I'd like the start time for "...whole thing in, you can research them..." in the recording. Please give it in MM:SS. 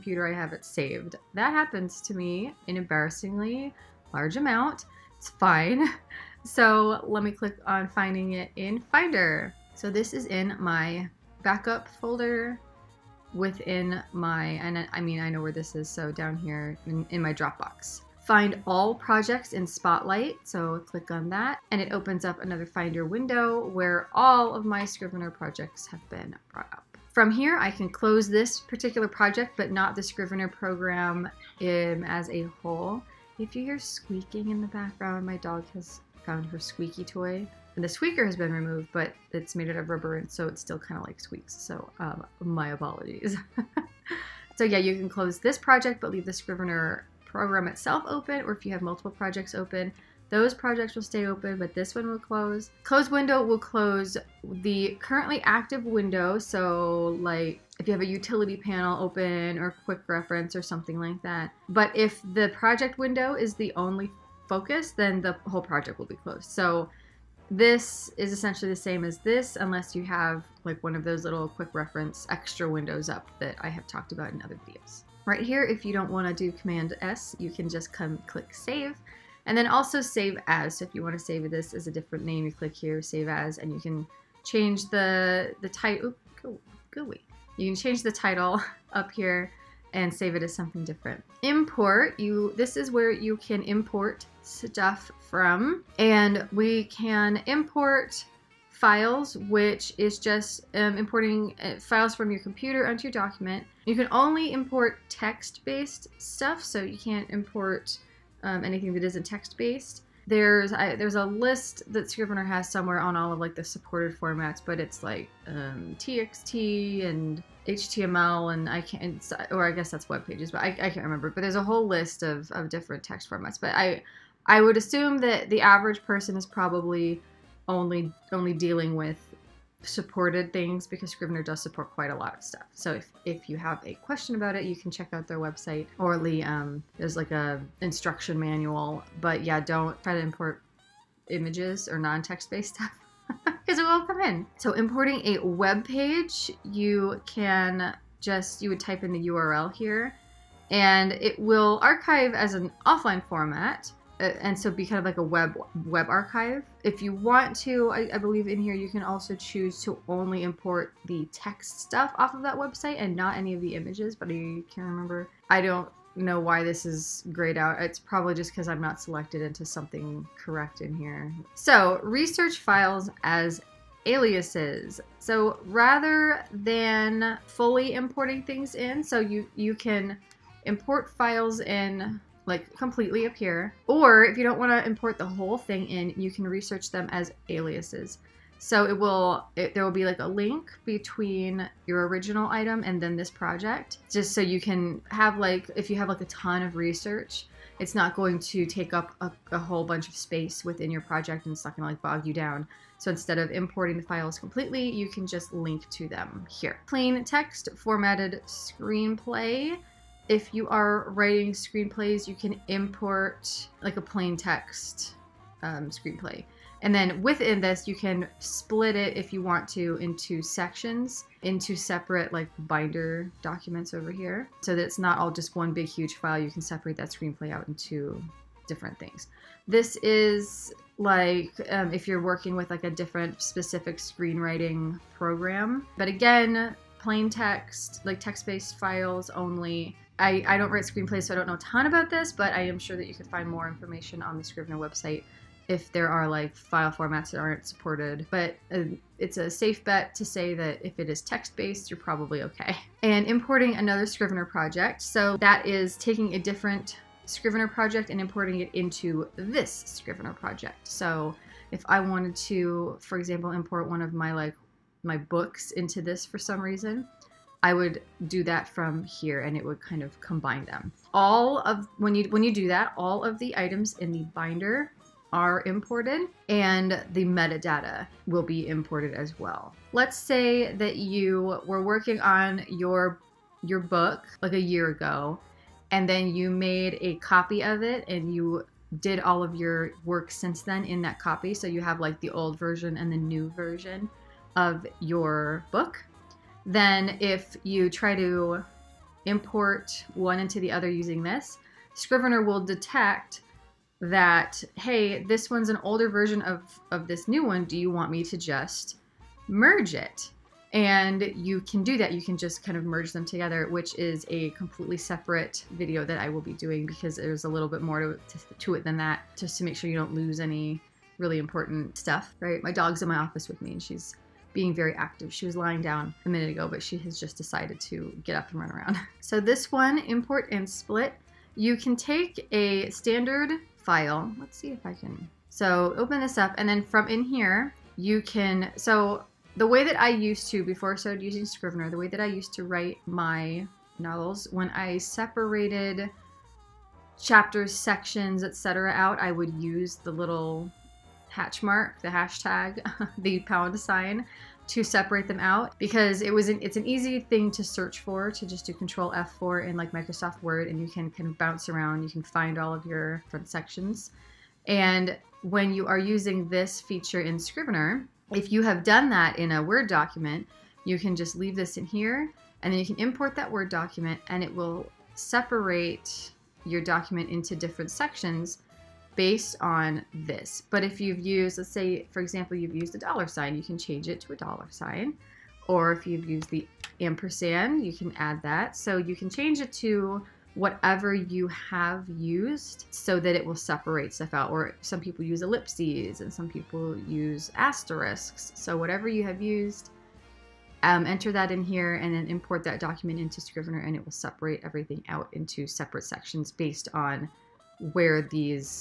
03:05.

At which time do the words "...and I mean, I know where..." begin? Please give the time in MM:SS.
00:14.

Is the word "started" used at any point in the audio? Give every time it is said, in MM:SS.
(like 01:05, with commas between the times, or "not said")
05:40.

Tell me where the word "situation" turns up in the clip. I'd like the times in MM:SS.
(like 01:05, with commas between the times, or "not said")
not said.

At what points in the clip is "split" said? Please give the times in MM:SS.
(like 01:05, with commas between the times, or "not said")
03:38, 05:30.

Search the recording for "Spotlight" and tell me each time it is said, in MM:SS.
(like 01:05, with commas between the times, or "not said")
00:19.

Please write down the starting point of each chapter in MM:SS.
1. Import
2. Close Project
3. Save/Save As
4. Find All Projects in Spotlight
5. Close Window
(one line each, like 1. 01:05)
1. 01:31
2. 00:28
3. 01:15
4. 00:18
5. 00:53.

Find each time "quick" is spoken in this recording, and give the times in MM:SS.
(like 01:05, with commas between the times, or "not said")
00:59, 01:11.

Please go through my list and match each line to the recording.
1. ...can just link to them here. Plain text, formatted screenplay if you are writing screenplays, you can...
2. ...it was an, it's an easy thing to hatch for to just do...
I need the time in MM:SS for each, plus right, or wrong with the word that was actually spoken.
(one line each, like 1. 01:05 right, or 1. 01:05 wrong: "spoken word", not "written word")
1. 03:25 right
2. 05:56 wrong: "search", not "hatch".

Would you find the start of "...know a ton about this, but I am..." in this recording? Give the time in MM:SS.
04:01.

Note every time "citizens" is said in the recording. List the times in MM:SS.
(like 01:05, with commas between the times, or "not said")
not said.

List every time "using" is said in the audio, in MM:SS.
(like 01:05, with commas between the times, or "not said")
05:00, 05:41, 06:05.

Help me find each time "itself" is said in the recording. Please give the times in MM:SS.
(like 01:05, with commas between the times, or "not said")
00:47.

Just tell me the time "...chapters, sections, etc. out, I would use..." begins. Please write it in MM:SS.
05:47.